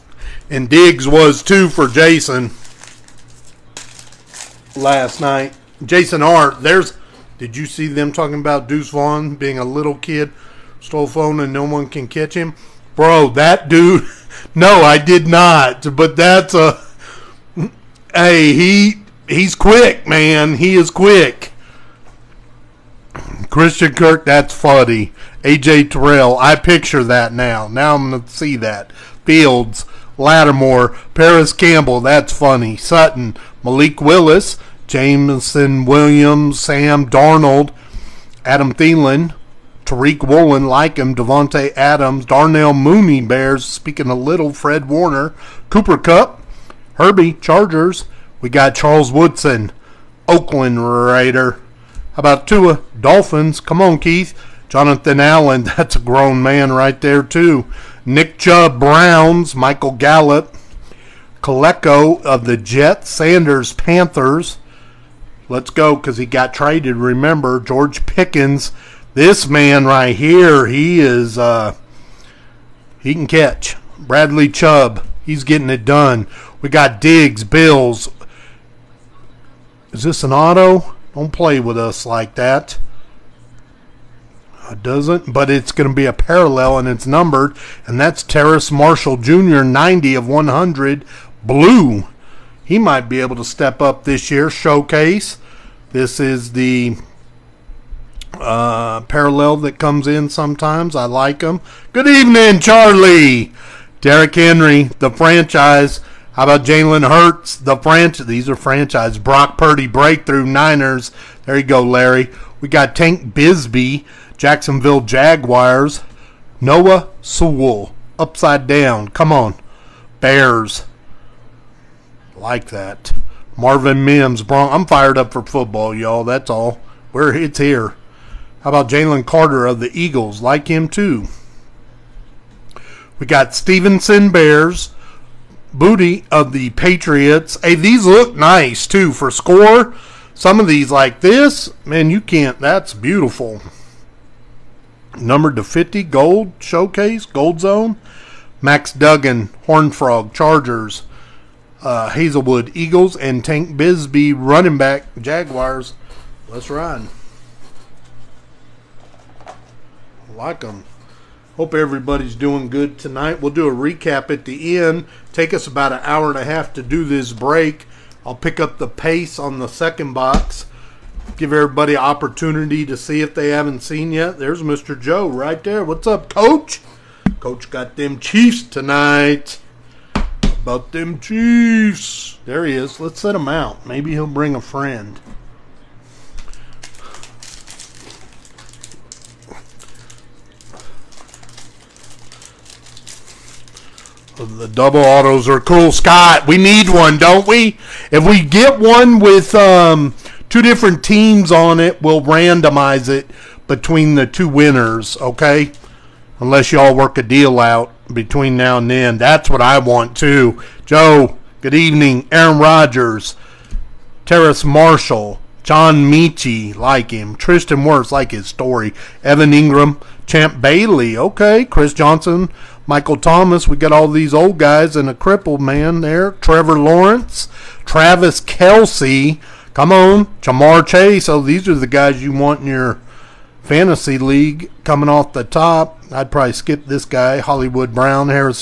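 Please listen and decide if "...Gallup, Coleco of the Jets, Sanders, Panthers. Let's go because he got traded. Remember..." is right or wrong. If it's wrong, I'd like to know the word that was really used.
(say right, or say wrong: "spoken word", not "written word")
right.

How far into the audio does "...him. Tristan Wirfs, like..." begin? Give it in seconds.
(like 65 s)
217 s.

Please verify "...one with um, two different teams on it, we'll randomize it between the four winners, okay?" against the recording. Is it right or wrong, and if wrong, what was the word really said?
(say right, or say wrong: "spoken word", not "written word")
wrong: "two", not "four".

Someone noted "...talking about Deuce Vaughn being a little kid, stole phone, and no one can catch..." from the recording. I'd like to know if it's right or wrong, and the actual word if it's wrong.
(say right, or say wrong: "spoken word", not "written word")
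right.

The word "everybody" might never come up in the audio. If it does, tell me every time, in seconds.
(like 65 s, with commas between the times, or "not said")
161 s, 171 s.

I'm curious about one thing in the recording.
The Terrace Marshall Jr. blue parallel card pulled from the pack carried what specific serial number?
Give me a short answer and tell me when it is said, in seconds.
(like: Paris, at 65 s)
90 of 100, at 89 s.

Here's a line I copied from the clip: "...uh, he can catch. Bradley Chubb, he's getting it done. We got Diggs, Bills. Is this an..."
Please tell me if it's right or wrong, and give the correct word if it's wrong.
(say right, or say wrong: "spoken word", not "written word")
right.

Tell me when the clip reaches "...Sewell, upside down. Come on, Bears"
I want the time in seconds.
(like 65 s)
117 s.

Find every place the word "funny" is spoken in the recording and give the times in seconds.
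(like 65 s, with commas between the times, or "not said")
24 s, 32 s.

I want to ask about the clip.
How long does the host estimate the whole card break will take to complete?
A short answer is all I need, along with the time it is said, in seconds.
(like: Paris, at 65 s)
An hour and a half, at 165 s.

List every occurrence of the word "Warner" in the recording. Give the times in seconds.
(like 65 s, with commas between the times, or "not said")
44 s.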